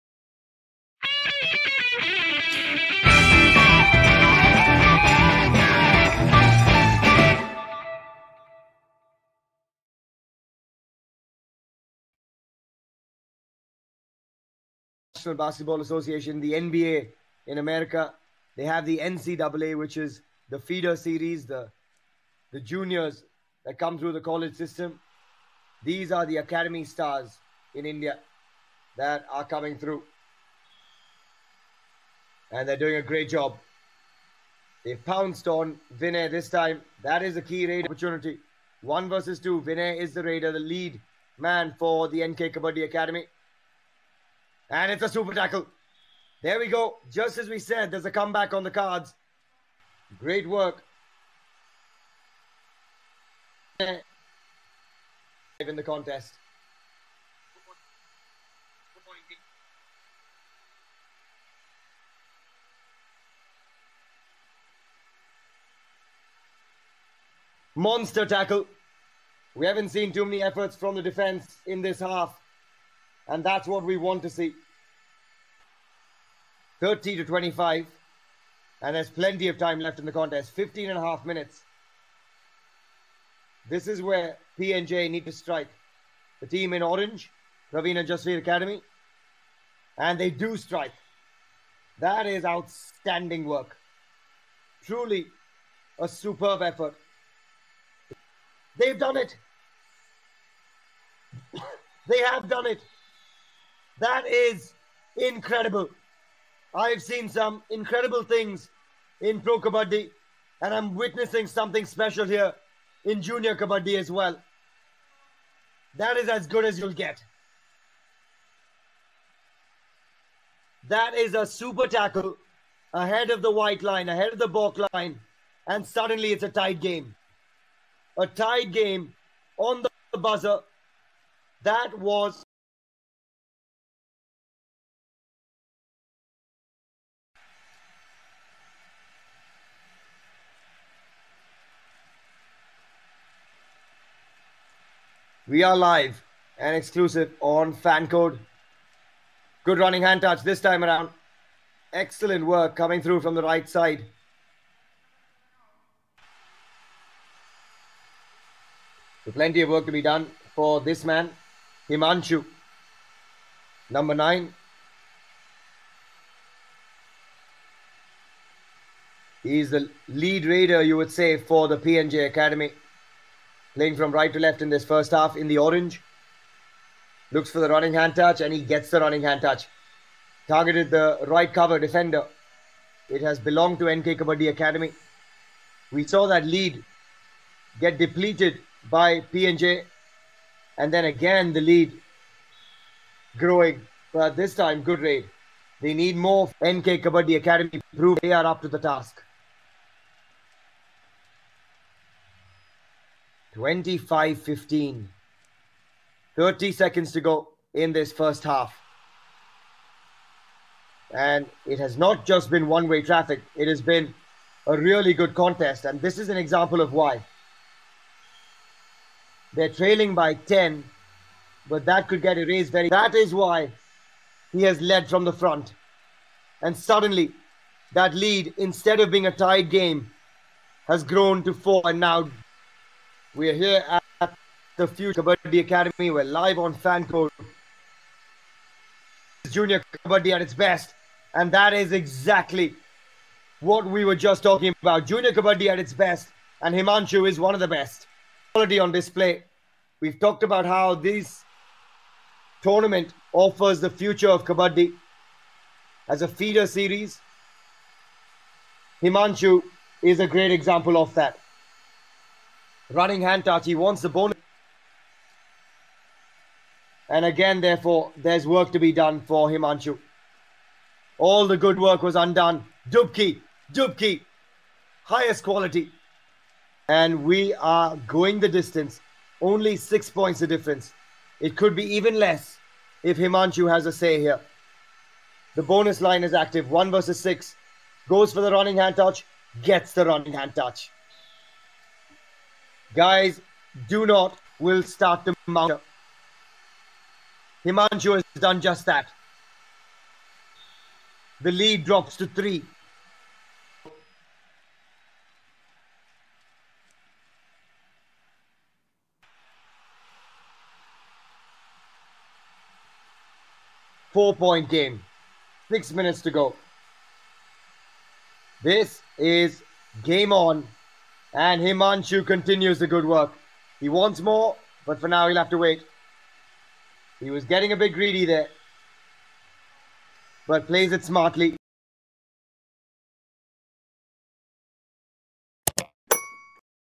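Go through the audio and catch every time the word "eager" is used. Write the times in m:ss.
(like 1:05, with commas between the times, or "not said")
not said.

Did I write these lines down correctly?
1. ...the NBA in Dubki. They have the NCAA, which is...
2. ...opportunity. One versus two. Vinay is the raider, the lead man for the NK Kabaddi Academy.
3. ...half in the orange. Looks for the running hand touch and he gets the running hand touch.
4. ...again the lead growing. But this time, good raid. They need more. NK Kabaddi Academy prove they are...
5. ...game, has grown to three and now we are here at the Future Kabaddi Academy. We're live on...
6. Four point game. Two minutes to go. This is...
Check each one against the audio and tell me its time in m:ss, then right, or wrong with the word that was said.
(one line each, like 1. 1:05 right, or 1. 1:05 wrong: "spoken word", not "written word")
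1. 0:16 wrong: "America", not "Dubki"
2. 0:37 right
3. 2:55 right
4. 3:11 right
5. 3:49 wrong: "four", not "three"
6. 5:14 wrong: "Six", not "Two".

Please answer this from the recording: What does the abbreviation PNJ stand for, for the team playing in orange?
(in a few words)
Parveen Jasvir Academy.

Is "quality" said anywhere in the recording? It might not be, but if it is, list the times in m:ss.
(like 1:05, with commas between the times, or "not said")
4:08, 4:35.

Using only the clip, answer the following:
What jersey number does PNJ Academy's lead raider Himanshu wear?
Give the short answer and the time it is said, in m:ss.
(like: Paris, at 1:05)
9, at 2:44.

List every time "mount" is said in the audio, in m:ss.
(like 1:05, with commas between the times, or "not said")
4:55.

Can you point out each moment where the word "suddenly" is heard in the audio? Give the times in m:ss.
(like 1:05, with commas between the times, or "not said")
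2:05, 3:46.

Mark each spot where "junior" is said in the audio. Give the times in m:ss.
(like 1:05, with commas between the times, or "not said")
0:22, 1:53, 3:59, 4:05.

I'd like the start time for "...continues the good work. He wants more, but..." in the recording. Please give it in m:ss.
5:22.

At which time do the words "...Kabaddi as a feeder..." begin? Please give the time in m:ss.
4:14.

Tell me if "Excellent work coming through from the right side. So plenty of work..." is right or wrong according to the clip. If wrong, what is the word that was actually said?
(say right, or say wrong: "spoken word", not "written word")
right.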